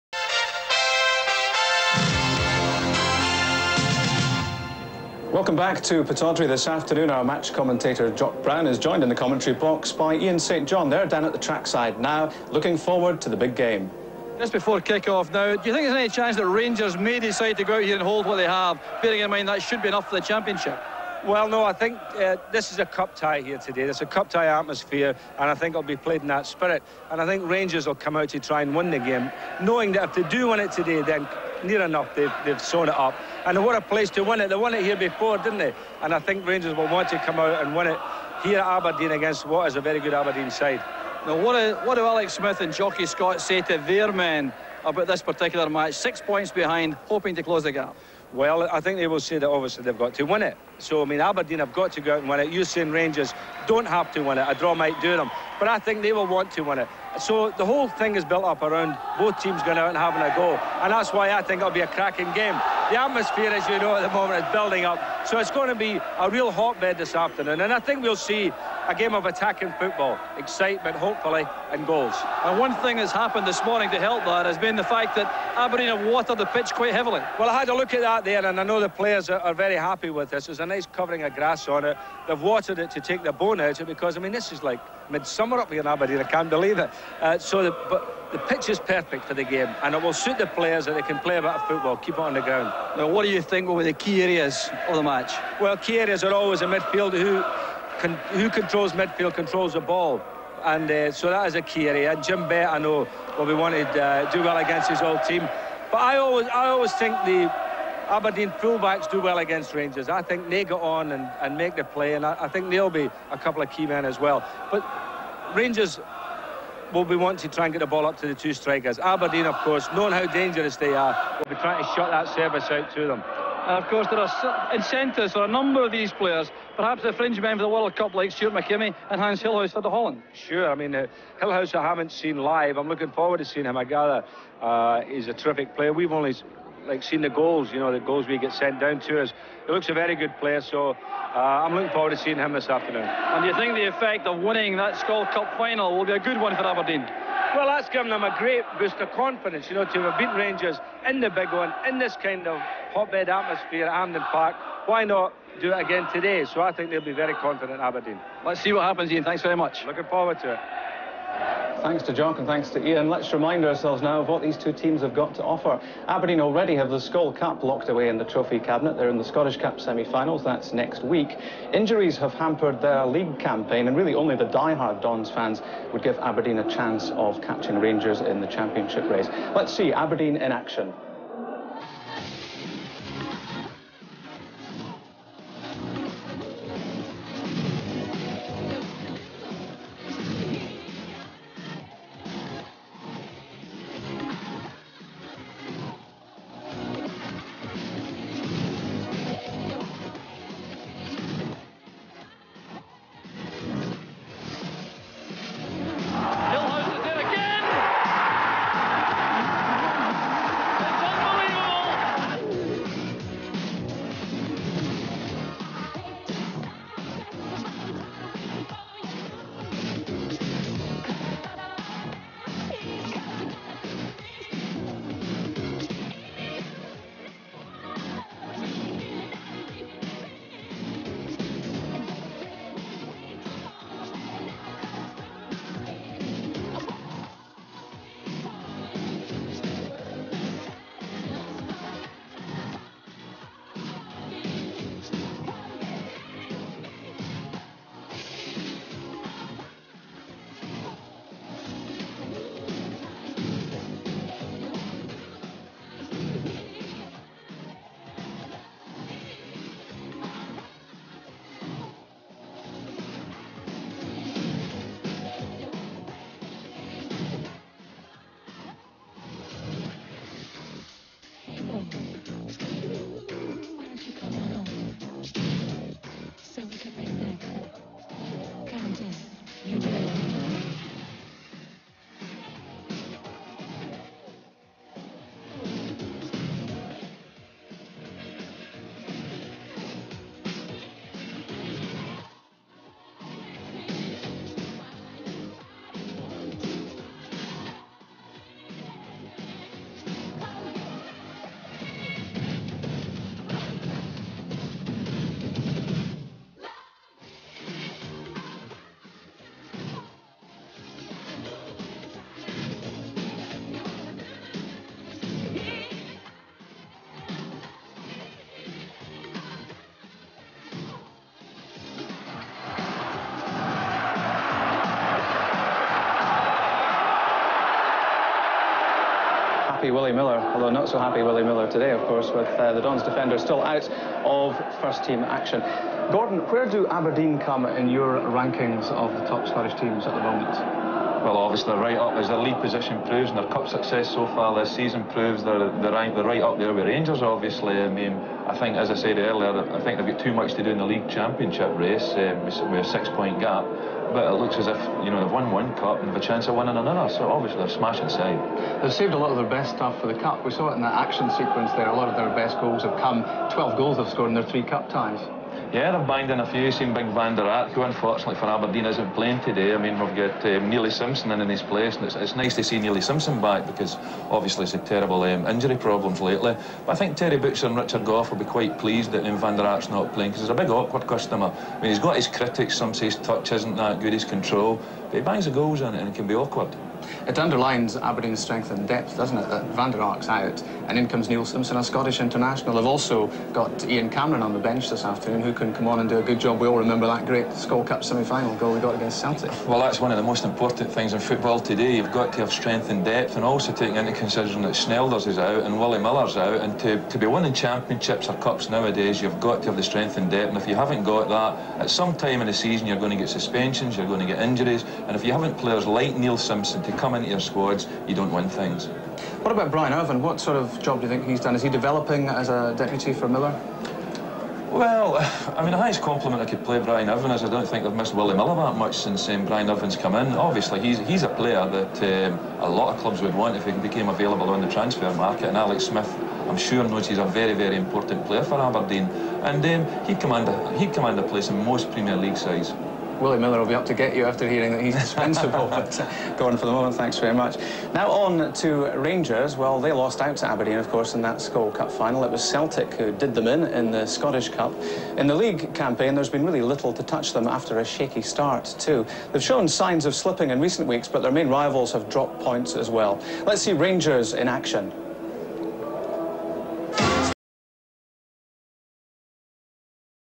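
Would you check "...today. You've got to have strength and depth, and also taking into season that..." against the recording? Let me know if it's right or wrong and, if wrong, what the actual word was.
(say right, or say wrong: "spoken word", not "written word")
wrong: "consideration", not "season".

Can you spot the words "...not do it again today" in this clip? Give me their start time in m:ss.
2:35.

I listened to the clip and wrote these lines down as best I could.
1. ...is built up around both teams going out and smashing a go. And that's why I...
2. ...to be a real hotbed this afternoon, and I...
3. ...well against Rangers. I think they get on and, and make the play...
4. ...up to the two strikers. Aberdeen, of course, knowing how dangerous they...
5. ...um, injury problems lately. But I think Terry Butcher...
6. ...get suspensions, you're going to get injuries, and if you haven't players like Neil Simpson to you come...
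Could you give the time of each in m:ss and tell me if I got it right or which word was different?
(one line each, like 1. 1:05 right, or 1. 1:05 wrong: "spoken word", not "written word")
1. 0:58 wrong: "having", not "smashing"
2. 1:05 right
3. 1:49 right
4. 1:58 right
5. 6:15 right
6. 6:53 right.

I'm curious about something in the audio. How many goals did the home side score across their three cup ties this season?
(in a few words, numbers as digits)
12.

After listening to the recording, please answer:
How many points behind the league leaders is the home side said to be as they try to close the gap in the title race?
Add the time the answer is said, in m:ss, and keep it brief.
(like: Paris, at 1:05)
6, at 0:45.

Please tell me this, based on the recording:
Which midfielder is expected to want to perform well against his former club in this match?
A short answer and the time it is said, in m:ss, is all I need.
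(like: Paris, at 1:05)
Jim Bett, at 1:42.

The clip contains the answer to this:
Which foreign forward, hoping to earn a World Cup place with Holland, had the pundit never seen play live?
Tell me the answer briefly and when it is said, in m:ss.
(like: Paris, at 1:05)
Hans Gillhaus, at 2:09.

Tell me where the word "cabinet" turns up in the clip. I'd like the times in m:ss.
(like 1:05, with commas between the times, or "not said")
2:48.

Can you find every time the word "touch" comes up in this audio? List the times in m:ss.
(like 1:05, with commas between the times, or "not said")
6:23, 7:37.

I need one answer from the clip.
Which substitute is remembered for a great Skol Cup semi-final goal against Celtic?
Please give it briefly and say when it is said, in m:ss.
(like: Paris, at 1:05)
Ian Cameron, at 6:33.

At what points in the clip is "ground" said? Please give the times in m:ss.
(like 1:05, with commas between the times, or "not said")
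1:32.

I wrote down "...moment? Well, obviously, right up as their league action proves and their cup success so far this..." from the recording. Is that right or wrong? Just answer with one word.
wrong.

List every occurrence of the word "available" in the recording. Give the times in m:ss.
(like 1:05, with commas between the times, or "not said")
7:14.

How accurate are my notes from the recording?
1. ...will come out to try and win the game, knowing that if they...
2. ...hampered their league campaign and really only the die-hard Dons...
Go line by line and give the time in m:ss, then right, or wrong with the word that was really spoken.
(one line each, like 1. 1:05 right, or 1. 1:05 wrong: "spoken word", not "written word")
1. 0:27 right
2. 2:52 right.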